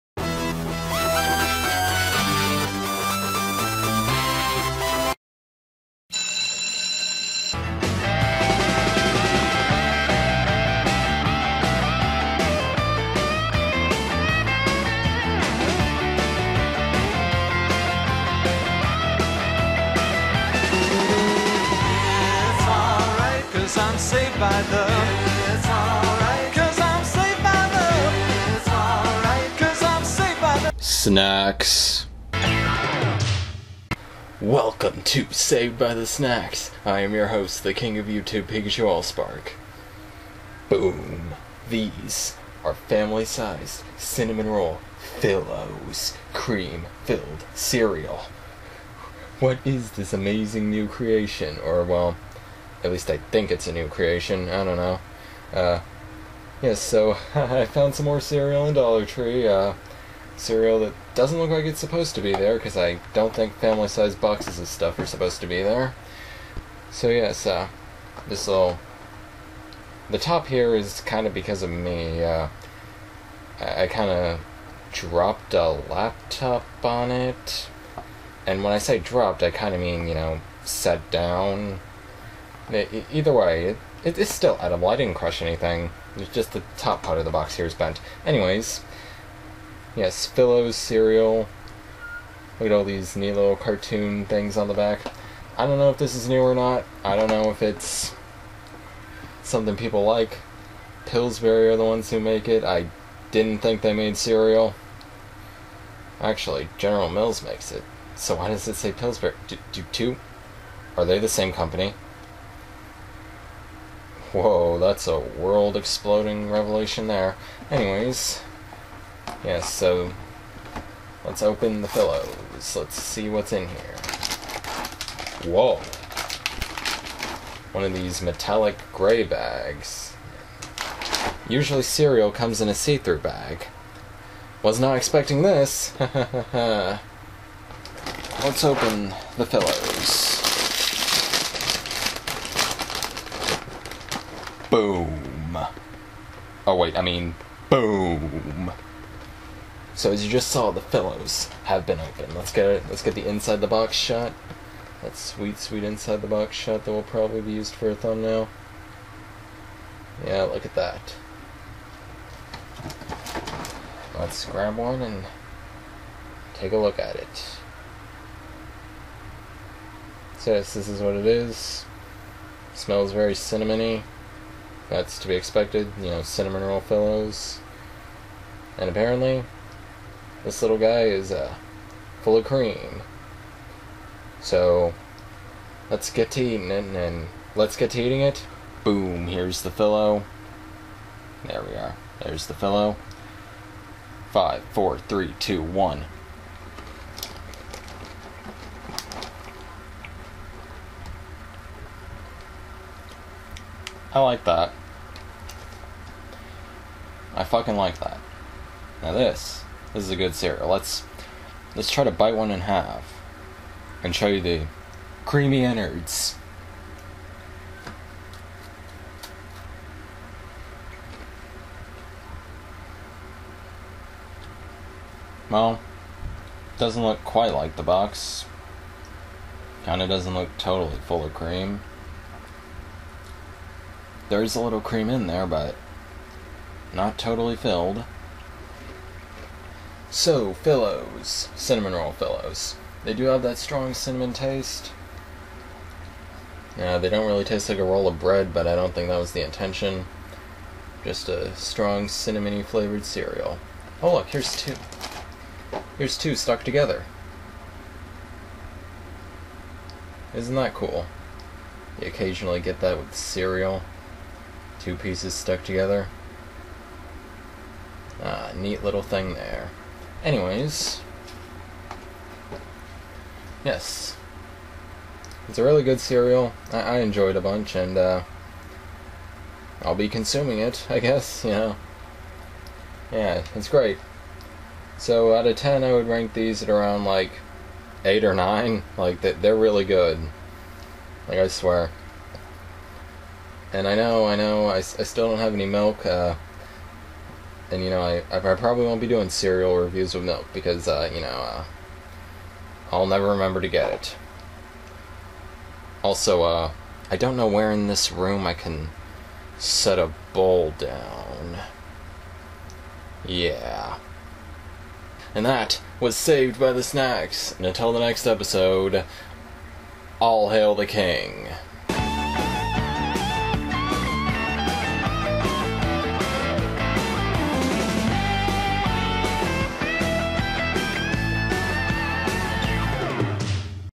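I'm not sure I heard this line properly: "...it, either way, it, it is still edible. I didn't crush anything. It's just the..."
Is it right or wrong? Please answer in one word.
right.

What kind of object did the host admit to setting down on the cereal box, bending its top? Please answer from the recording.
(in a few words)
laptop.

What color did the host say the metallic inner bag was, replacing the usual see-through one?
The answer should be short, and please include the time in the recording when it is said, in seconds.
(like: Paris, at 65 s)
gray, at 128 s.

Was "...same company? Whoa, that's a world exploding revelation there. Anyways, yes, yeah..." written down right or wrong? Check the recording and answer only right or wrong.
right.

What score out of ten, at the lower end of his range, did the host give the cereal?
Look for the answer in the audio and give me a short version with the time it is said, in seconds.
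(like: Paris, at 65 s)
8, at 288 s.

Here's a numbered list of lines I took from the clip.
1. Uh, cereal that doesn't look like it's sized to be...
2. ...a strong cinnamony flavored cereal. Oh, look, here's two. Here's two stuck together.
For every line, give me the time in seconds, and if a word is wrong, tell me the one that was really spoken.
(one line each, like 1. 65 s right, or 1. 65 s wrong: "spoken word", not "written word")
1. 59 s wrong: "supposed", not "sized"
2. 251 s right.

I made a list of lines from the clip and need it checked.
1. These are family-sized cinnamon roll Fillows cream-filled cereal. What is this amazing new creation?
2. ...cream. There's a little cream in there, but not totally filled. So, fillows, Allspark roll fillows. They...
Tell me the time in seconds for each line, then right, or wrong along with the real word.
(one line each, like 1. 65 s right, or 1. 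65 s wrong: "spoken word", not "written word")
1. 41 s right
2. 231 s wrong: "Cinnamon", not "Allspark".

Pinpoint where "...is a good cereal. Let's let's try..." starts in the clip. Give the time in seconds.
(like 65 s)
210 s.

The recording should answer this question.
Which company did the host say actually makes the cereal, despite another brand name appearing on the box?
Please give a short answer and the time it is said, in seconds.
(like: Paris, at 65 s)
General Mills, at 106 s.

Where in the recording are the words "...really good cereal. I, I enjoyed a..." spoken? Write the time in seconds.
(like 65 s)
275 s.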